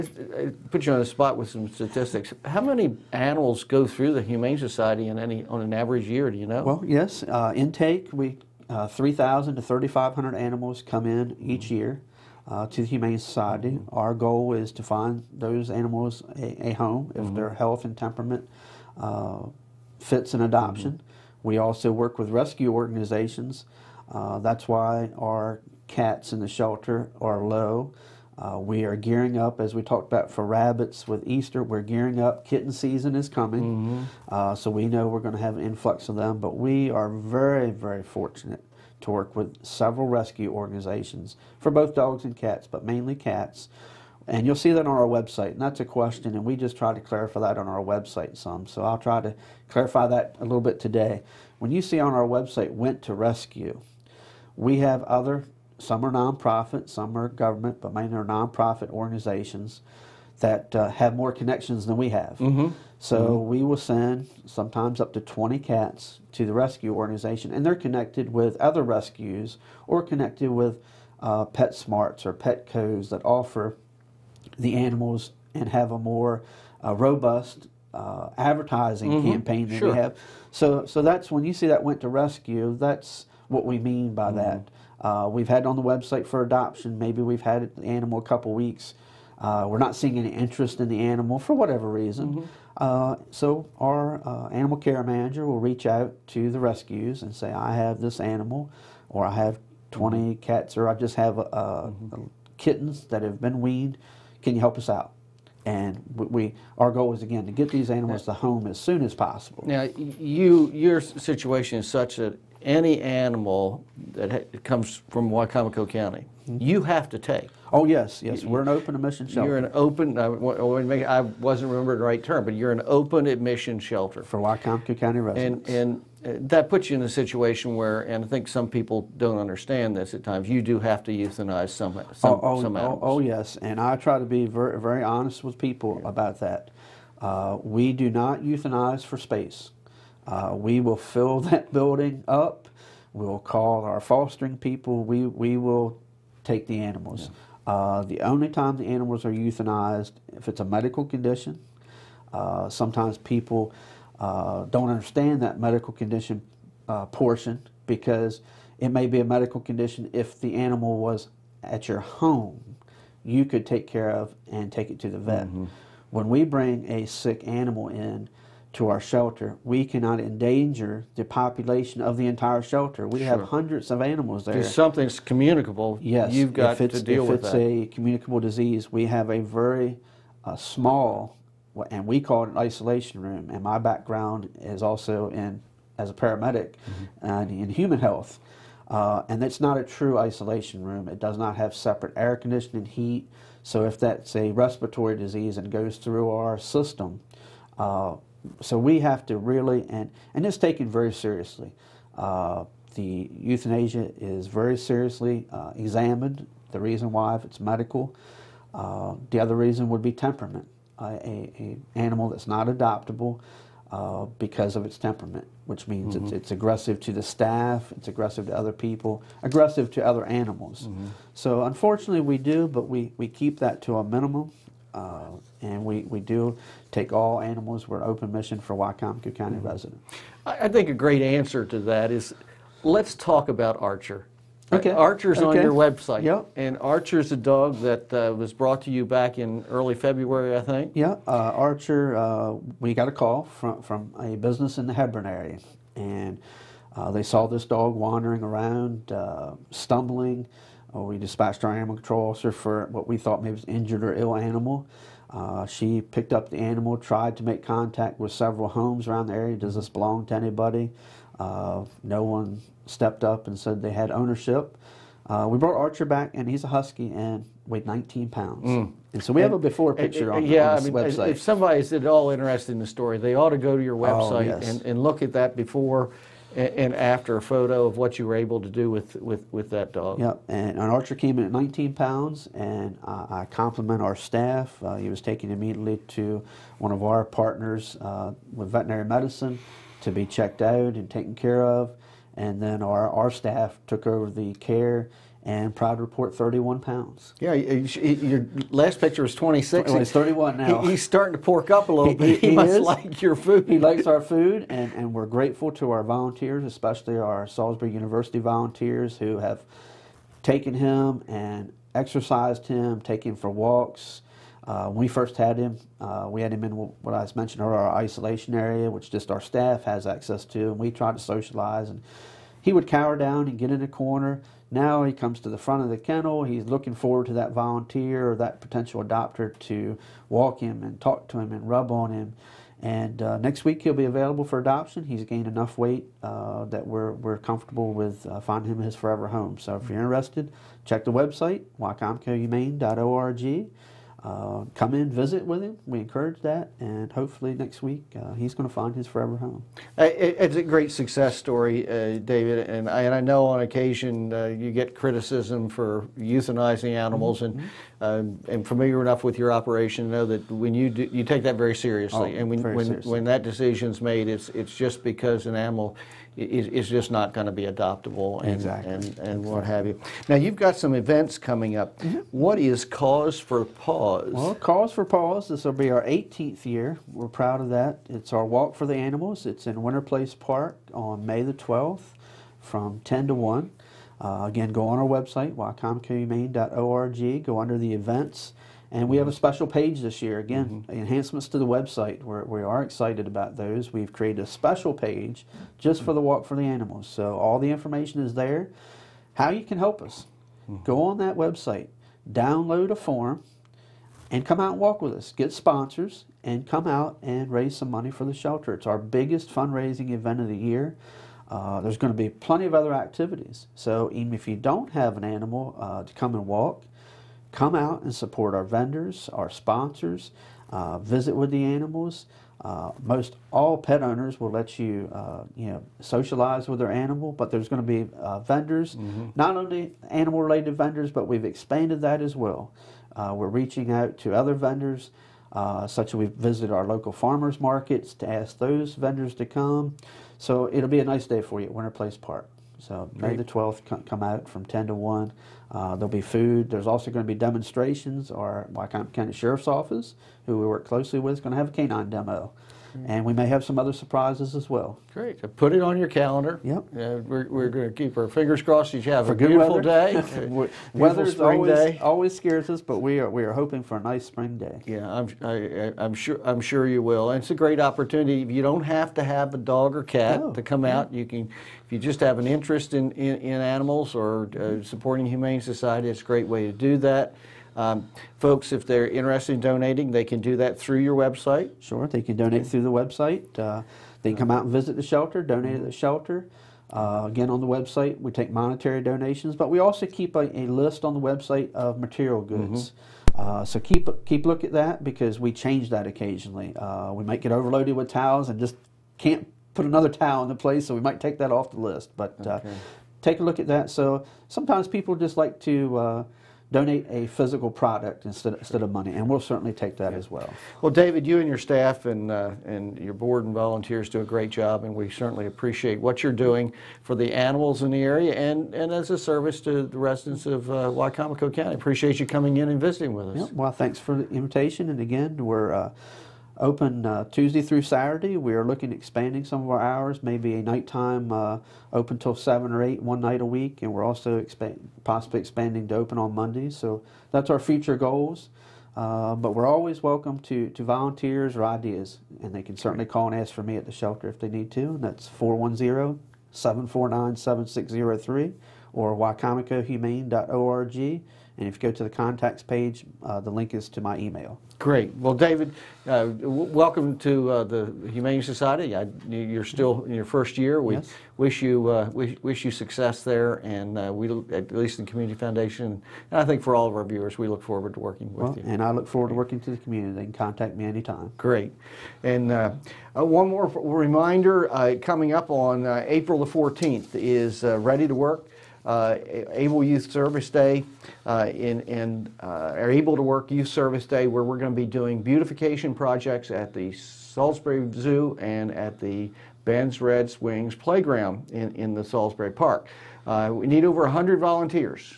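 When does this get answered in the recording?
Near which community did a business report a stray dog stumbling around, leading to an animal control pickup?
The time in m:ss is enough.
4:04.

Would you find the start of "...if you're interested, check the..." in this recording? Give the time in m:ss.
5:39.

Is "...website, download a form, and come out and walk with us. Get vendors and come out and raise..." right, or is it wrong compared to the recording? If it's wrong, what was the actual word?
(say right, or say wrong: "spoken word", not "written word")
wrong: "sponsors", not "vendors".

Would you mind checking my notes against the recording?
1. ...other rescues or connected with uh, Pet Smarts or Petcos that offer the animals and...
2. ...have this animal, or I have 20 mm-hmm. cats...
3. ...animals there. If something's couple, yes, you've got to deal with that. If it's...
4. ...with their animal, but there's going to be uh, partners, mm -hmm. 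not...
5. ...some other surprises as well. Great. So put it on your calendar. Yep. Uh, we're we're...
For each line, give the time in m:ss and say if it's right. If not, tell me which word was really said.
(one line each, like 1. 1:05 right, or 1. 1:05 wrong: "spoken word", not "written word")
1. 1:08 right
2. 1:37 right
3. 2:54 wrong: "communicable", not "couple"
4. 7:06 wrong: "vendors", not "partners"
5. 7:33 right.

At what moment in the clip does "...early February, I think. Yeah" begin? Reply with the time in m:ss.
3:59.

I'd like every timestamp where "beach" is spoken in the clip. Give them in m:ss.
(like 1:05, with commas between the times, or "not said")
not said.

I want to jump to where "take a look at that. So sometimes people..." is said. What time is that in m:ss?
8:23.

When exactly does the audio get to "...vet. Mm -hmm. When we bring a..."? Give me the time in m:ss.
2:45.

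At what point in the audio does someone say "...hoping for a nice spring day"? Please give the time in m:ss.
7:43.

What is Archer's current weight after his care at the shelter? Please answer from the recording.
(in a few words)
31 pounds.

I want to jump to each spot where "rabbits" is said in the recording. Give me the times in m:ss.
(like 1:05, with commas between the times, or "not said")
0:30.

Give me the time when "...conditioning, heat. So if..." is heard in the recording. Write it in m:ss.
3:12.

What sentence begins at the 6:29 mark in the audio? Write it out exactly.
special page this year, again, mm -hmm.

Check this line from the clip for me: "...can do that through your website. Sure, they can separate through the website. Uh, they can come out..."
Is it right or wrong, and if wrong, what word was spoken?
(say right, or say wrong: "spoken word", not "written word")
wrong: "donate", not "separate".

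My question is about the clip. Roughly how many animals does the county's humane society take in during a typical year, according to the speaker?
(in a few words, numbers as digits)
3,000 to 3,500.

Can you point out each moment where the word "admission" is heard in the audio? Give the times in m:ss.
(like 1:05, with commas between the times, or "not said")
1:58, 2:03.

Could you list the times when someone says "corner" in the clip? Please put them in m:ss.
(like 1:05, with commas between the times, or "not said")
5:23.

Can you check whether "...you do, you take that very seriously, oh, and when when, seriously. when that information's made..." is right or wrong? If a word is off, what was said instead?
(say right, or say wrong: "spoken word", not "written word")
wrong: "decision", not "information".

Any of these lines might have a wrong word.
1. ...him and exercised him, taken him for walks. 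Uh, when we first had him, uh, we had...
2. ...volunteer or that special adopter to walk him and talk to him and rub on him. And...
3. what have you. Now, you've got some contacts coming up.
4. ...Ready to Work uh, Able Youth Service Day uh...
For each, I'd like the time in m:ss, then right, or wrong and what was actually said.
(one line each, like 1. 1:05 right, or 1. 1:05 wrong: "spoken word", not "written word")
1. 5:10 right
2. 5:27 wrong: "potential", not "special"
3. 6:09 wrong: "events", not "contacts"
4. 9:37 right.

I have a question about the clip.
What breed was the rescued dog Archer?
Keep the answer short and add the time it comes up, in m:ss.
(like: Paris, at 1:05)
Husky, at 4:26.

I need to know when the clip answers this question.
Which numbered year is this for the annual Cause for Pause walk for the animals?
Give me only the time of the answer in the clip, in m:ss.
6:16.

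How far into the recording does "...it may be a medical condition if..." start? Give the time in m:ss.
2:38.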